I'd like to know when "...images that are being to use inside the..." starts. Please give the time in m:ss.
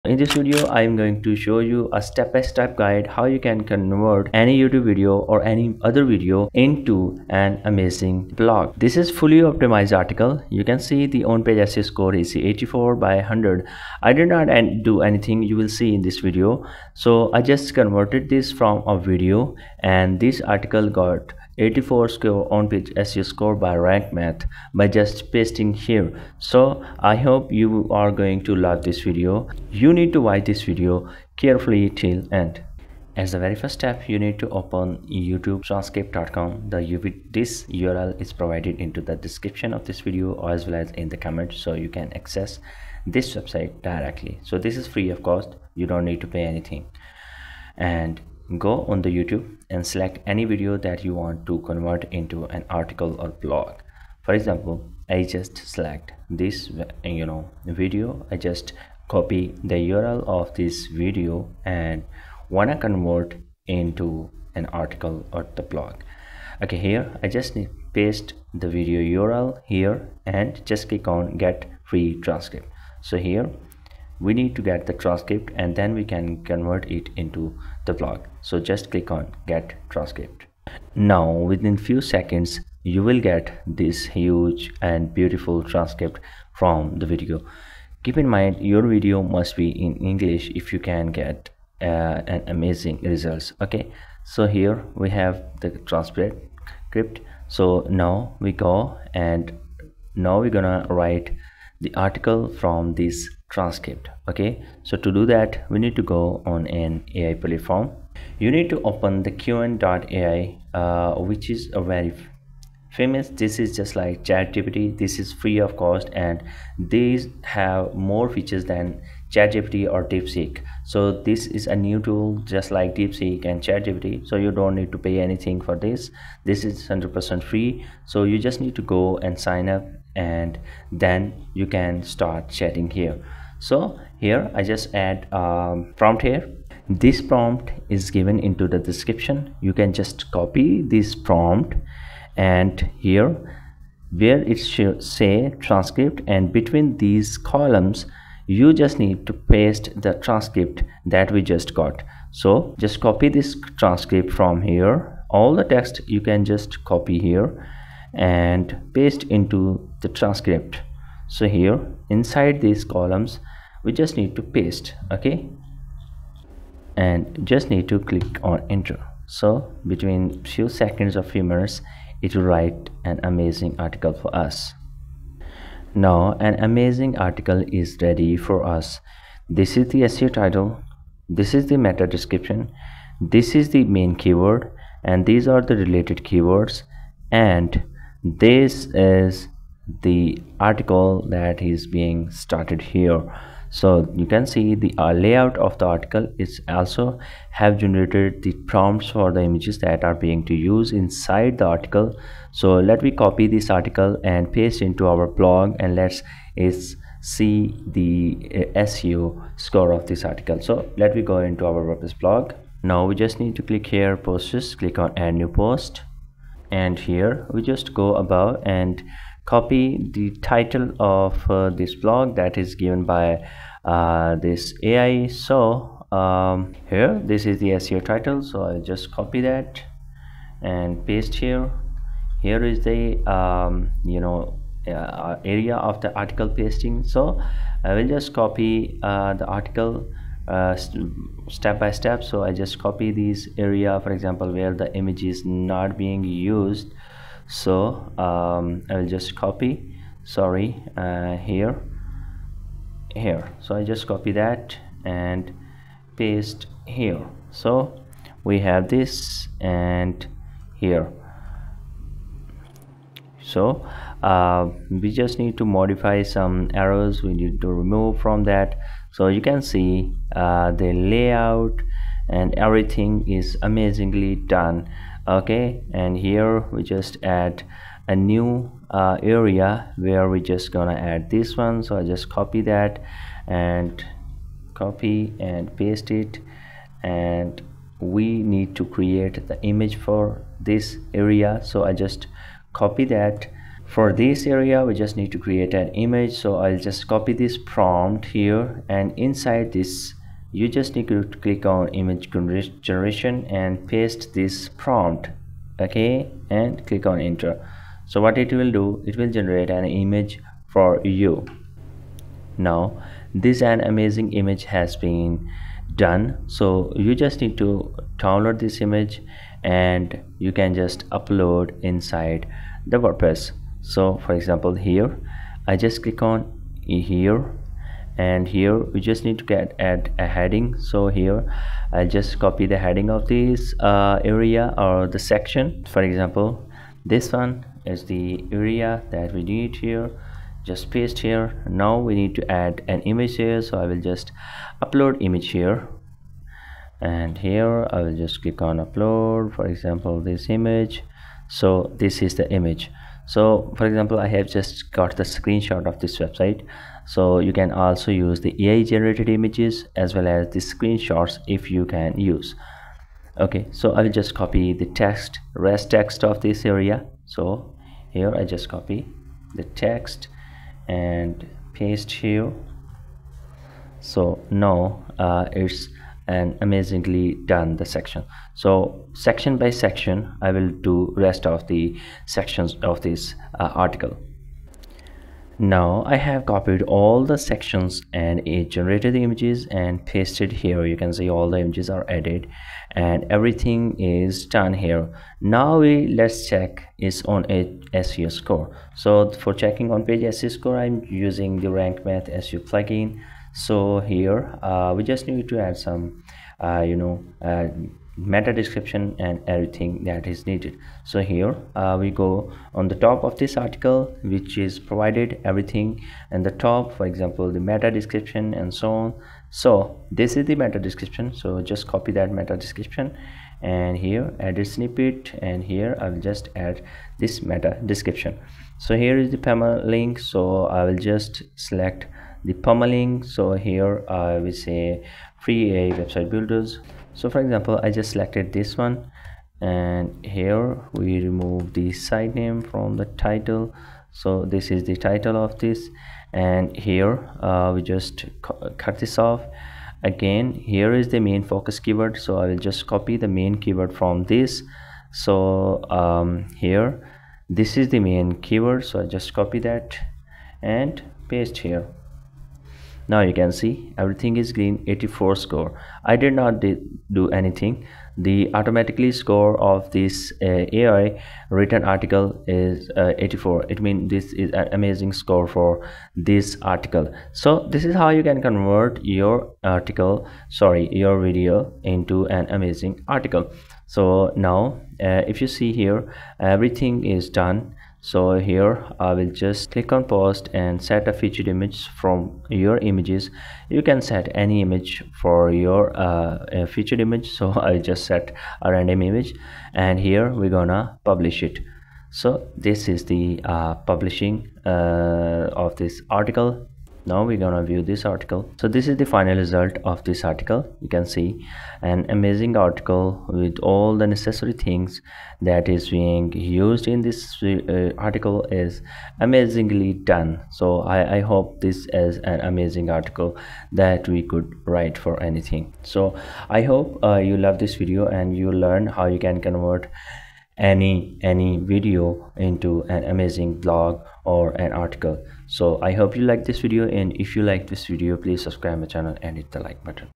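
3:19.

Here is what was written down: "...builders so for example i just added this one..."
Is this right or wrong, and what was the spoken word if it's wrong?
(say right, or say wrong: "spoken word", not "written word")
wrong: "selected", not "added".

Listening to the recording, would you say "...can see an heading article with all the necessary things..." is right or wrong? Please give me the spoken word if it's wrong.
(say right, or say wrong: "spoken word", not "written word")
wrong: "amazing", not "heading".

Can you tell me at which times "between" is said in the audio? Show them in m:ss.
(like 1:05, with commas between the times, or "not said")
2:26, 2:49.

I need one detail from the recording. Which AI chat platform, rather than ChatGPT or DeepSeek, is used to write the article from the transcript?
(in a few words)
qwen.ai.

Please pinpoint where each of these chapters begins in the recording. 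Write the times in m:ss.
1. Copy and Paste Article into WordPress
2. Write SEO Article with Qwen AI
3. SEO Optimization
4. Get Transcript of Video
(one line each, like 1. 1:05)
1. 3:35
2. 1:50
3. 6:53
4. 0:33.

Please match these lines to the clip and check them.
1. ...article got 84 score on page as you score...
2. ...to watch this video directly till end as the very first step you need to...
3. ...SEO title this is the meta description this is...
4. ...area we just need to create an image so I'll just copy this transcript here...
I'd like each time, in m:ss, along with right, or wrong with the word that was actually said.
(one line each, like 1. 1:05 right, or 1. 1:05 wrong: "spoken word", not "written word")
1. 0:20 right
2. 0:30 wrong: "carefully", not "directly"
3. 3:00 right
4. 4:54 wrong: "prompt", not "transcript".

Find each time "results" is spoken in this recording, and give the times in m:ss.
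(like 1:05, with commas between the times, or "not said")
1:33, 8:29.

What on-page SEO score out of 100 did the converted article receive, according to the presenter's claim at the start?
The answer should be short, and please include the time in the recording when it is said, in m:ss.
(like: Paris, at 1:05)
84, at 0:12.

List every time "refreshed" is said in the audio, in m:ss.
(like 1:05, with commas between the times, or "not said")
not said.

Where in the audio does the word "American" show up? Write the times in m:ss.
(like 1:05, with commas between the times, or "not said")
not said.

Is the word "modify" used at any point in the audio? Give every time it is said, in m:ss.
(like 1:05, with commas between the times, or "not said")
4:25.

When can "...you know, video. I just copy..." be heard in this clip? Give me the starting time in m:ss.
0:57.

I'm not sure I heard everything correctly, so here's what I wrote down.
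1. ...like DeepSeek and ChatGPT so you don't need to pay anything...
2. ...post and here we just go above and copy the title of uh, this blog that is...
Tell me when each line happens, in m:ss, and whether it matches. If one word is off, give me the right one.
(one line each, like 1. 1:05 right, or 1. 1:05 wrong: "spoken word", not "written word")
1. 2:02 right
2. 3:35 right.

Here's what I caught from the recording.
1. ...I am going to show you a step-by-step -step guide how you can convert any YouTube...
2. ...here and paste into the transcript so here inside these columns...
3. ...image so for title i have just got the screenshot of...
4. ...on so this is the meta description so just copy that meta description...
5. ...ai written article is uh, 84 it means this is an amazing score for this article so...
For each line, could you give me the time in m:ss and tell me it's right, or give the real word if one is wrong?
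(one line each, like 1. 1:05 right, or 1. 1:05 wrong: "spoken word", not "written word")
1. 0:00 right
2. 2:37 right
3. 5:52 wrong: "example", not "title"
4. 6:58 right
5. 7:50 right.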